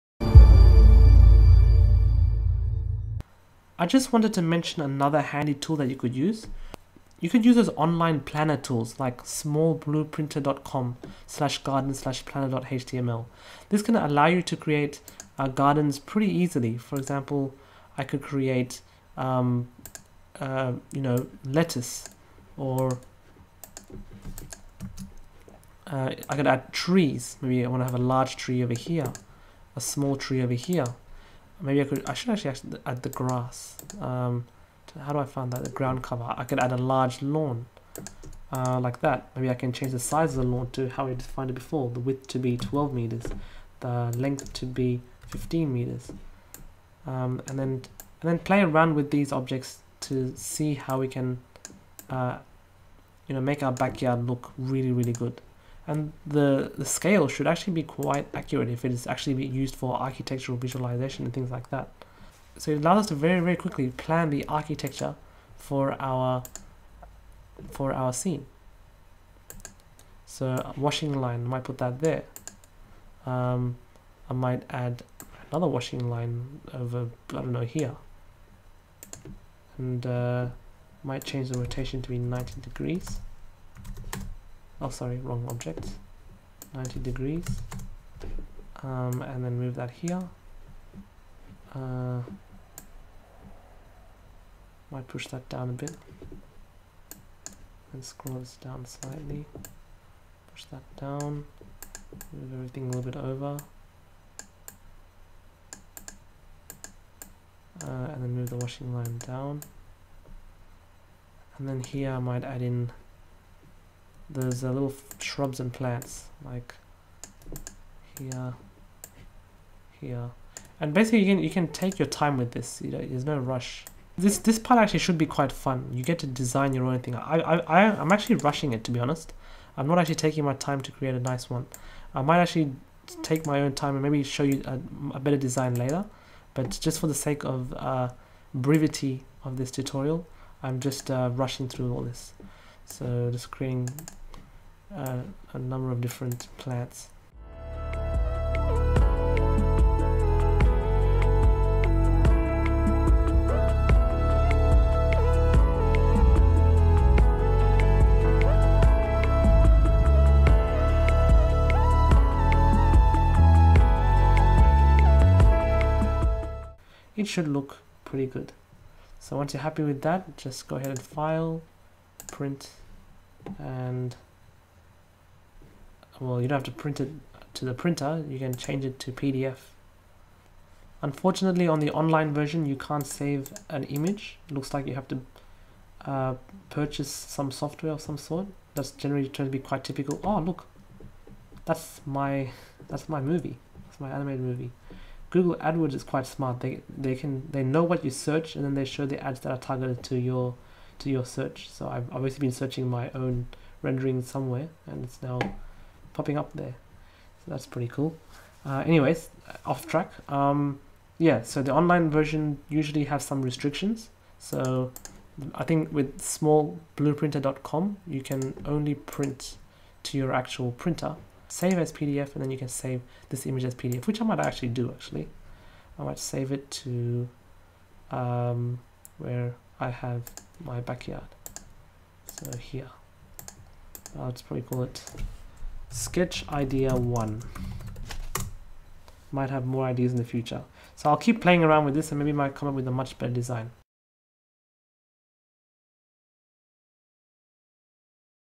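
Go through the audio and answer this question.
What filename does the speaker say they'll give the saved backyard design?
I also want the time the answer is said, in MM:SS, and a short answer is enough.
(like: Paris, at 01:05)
sketch idea one, at 03:55.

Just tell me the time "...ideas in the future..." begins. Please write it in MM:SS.
03:59.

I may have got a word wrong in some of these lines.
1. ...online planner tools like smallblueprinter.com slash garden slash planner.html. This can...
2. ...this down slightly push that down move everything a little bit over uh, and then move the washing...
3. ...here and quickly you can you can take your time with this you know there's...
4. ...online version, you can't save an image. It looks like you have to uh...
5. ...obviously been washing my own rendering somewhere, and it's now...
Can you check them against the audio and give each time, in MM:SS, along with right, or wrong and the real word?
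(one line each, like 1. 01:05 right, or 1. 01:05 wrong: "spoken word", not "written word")
1. 00:07 right
2. 01:38 right
3. 01:59 wrong: "basically", not "quickly"
4. 03:01 right
5. 03:22 wrong: "searching", not "washing".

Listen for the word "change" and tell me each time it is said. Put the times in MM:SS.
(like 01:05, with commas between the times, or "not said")
00:39, 01:21, 02:58.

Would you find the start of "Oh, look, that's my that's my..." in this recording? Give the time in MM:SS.
03:10.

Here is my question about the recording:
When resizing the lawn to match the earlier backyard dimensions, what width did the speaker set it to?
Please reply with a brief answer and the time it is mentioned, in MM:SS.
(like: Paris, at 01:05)
12 meters, at 00:42.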